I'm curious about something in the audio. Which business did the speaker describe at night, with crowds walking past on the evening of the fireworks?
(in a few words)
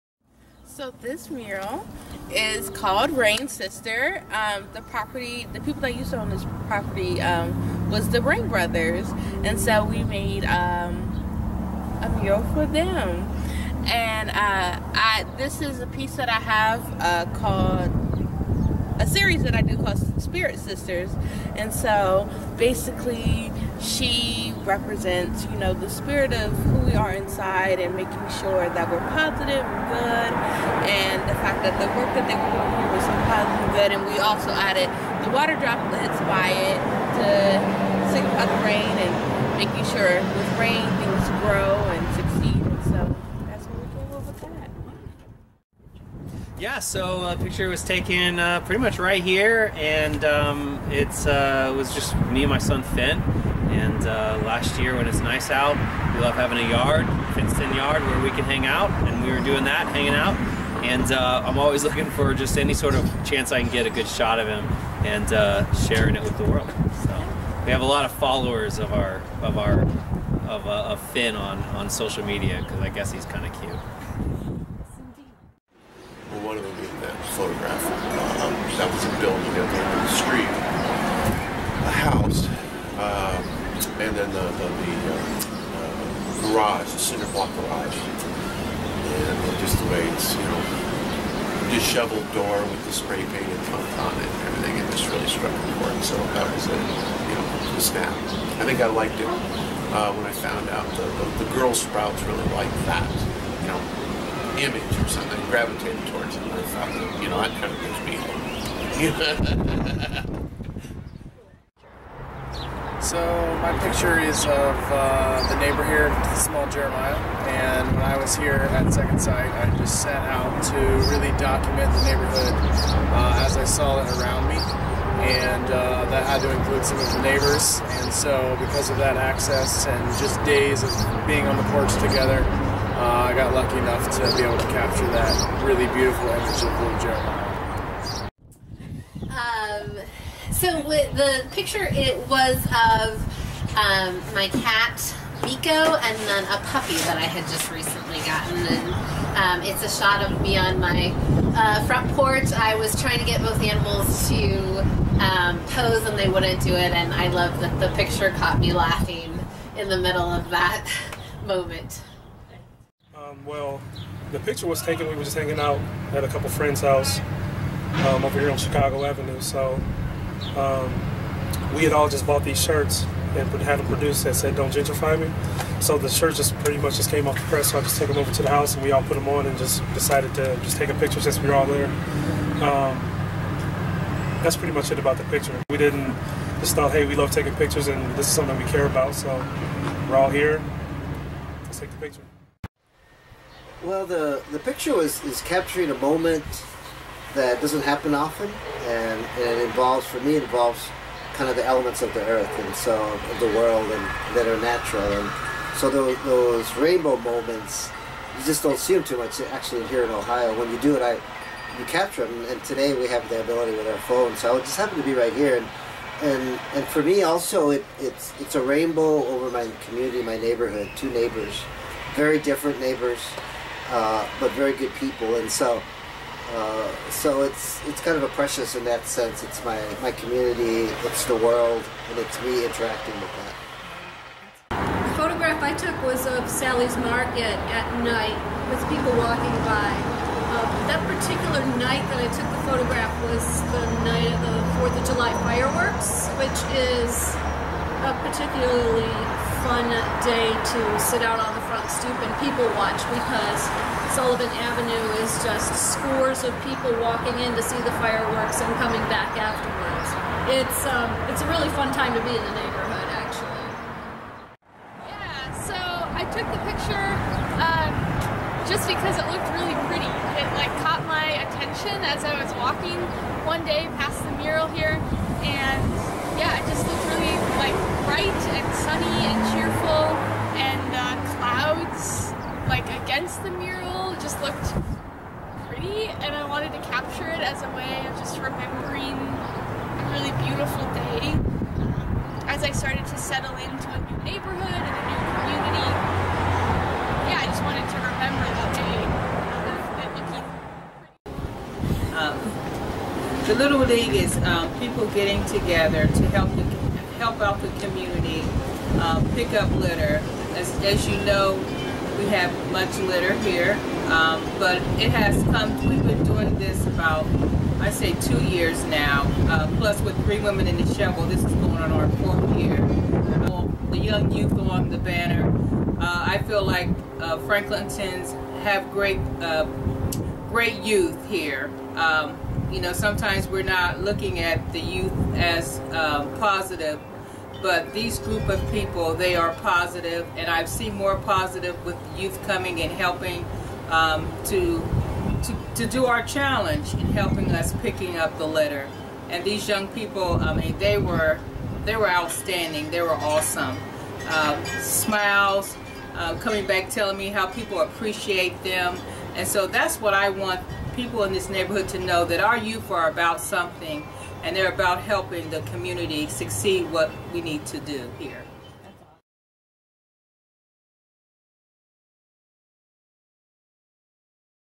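Sally's Market.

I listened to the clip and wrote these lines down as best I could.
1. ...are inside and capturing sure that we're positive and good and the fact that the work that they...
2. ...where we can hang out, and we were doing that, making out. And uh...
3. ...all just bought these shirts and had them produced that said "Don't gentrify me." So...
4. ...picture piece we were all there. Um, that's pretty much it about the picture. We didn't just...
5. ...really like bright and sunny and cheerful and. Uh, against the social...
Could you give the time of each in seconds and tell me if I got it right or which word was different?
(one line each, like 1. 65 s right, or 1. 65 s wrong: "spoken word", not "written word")
1. 26 s wrong: "making", not "capturing"
2. 58 s wrong: "hanging", not "making"
3. 171 s right
4. 180 s wrong: "since", not "piece"
5. 277 s wrong: "mural", not "social".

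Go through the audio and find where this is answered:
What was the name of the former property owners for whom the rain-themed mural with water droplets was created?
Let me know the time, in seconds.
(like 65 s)
8 s.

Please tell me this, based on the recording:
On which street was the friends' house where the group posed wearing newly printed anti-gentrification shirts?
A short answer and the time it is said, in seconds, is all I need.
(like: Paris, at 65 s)
Chicago Avenue, at 168 s.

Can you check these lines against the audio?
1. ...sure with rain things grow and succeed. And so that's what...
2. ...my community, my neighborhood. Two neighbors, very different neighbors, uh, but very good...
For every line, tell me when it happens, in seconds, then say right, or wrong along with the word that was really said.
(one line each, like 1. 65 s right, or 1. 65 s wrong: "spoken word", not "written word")
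1. 39 s right
2. 219 s right.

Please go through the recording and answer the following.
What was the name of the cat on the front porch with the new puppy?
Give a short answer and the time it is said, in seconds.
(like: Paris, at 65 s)
Miko, at 145 s.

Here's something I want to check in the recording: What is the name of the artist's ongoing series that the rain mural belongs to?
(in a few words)
Spirit Sisters.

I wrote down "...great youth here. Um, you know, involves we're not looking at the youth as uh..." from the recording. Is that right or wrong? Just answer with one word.
wrong.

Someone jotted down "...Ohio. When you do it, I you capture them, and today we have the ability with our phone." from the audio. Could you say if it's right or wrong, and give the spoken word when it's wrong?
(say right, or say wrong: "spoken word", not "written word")
right.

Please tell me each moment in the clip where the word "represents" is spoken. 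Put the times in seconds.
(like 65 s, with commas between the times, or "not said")
24 s.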